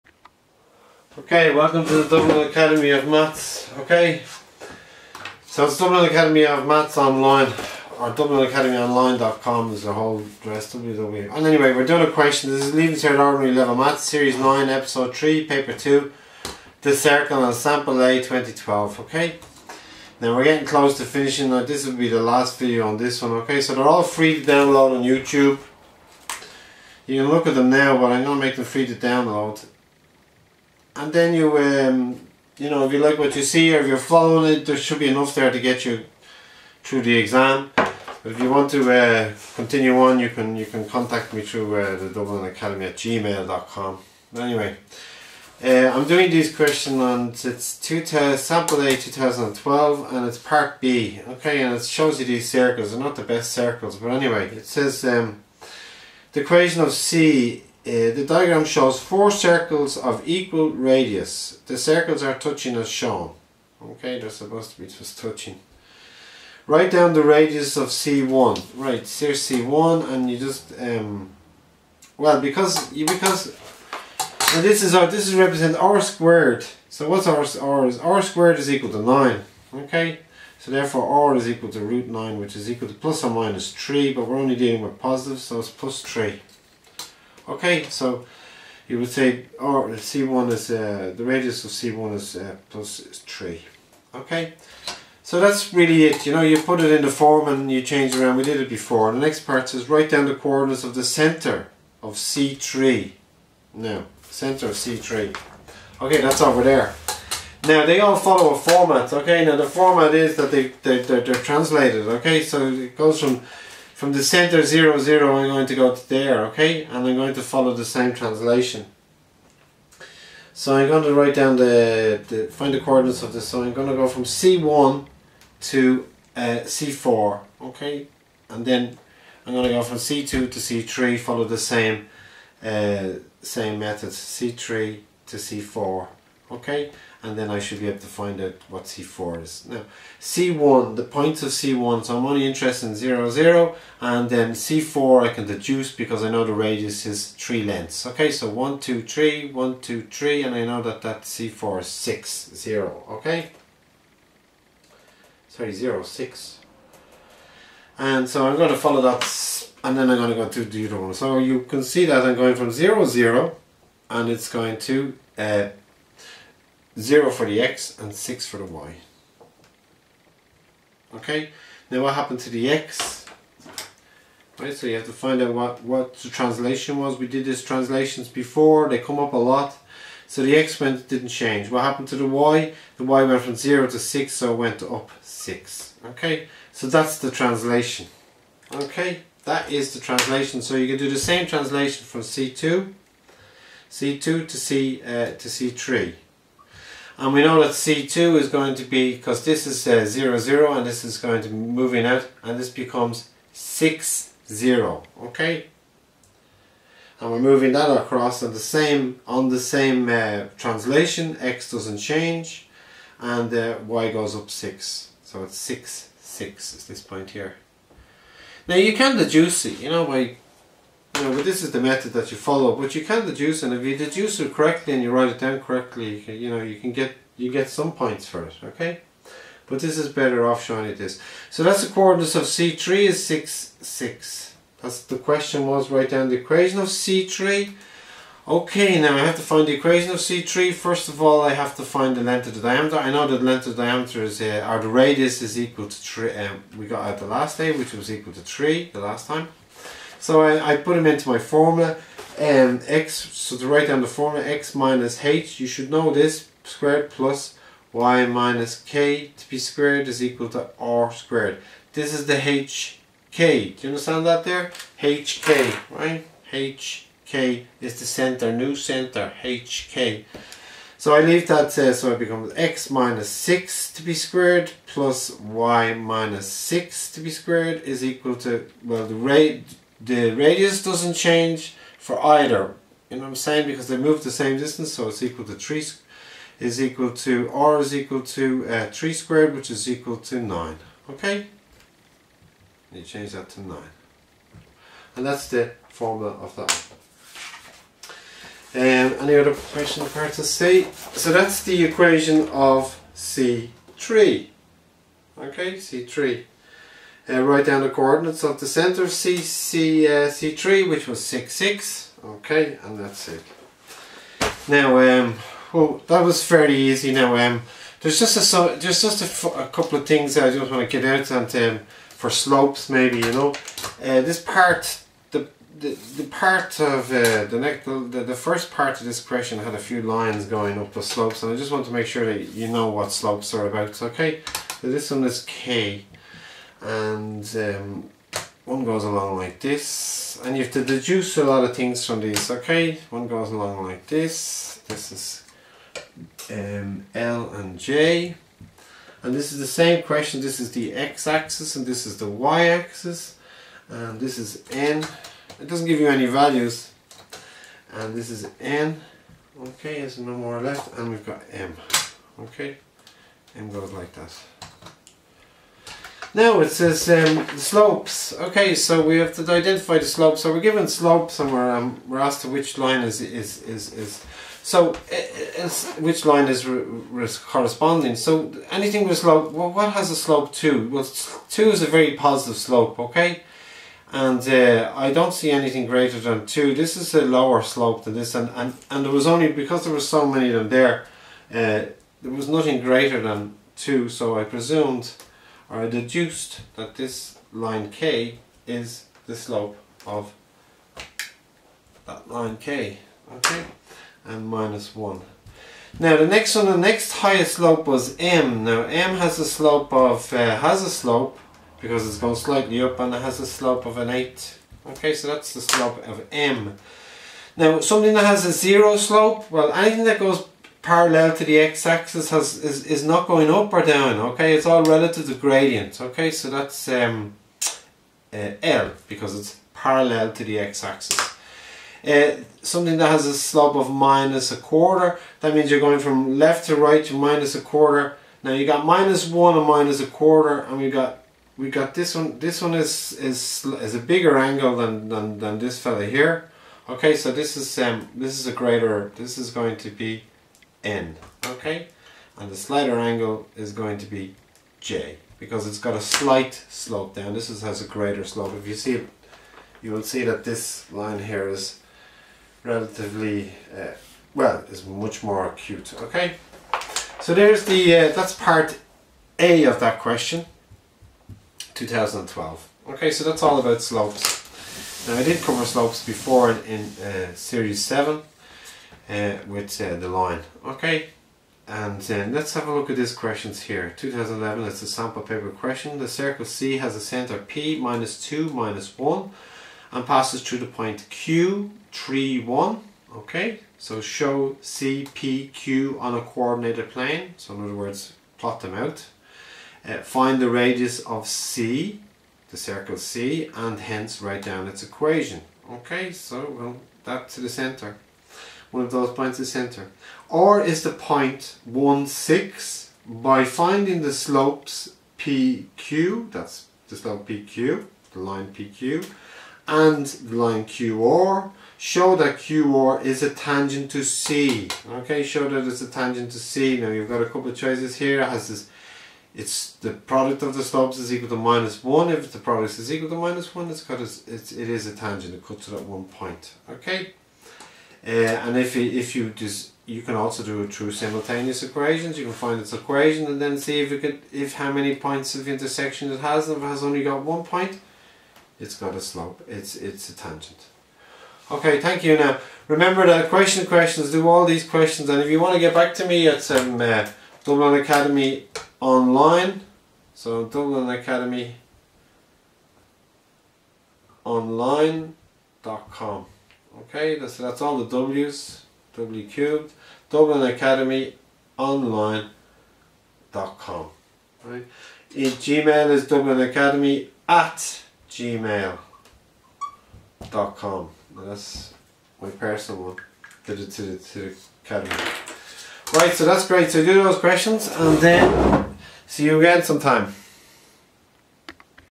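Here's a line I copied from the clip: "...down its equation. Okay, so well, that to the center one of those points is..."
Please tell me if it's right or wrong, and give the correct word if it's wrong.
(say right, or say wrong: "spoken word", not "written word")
right.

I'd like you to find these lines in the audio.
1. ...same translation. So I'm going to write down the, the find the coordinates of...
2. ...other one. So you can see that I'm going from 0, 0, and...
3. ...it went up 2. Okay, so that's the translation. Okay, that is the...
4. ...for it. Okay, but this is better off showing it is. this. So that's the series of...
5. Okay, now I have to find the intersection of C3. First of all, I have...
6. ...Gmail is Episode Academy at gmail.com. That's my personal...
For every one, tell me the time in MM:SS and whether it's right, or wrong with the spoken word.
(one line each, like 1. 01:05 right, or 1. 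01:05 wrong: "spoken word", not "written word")
1. 01:57 right
2. 02:40 right
3. 03:04 wrong: "6", not "2"
4. 03:48 wrong: "coordinates", not "series"
5. 03:58 wrong: "equation", not "intersection"
6. 09:35 wrong: "Dublin", not "Episode".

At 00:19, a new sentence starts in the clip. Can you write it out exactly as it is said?
Okay, now we're getting close to finishing.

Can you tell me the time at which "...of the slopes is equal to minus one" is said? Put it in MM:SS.
08:50.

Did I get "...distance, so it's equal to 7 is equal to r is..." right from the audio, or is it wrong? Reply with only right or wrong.
wrong.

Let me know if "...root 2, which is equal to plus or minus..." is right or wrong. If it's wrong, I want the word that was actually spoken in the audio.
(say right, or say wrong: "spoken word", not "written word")
wrong: "9", not "2".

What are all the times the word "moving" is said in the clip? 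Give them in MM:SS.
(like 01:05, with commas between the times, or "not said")
03:21, 03:27.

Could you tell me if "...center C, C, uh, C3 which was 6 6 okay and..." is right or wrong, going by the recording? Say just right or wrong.
right.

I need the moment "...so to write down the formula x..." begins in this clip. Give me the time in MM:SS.
04:13.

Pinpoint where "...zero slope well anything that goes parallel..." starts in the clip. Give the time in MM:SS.
06:58.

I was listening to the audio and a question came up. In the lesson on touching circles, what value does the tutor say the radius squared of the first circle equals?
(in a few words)
9.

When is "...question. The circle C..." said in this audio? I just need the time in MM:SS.
08:05.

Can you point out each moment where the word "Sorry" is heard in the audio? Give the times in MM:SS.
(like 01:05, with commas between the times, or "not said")
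02:35.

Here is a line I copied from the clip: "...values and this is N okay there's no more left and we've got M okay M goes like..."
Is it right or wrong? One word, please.
right.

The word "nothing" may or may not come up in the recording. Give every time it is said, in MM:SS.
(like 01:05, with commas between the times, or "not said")
06:32.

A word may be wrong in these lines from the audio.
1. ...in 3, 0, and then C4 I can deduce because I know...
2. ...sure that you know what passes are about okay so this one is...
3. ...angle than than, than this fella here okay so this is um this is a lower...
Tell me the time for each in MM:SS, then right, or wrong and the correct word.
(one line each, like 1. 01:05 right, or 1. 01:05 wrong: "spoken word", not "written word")
1. 02:22 wrong: "0", not "3"
2. 05:32 wrong: "slopes", not "passes"
3. 07:24 wrong: "greater", not "lower".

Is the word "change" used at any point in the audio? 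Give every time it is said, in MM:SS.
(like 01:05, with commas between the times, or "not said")
01:37, 03:01, 03:31, 04:41, 04:53.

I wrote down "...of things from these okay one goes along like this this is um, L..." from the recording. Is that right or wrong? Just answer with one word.
right.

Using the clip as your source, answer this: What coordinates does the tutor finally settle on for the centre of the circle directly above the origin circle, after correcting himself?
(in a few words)
(0, 6).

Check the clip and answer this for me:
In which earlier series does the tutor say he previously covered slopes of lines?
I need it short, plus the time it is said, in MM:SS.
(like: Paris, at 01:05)
Series 7, at 07:57.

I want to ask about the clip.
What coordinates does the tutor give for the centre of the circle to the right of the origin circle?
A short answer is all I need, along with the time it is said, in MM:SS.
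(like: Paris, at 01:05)
(6, 0), at 03:22.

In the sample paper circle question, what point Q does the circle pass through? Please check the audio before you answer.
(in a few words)
(3, 1).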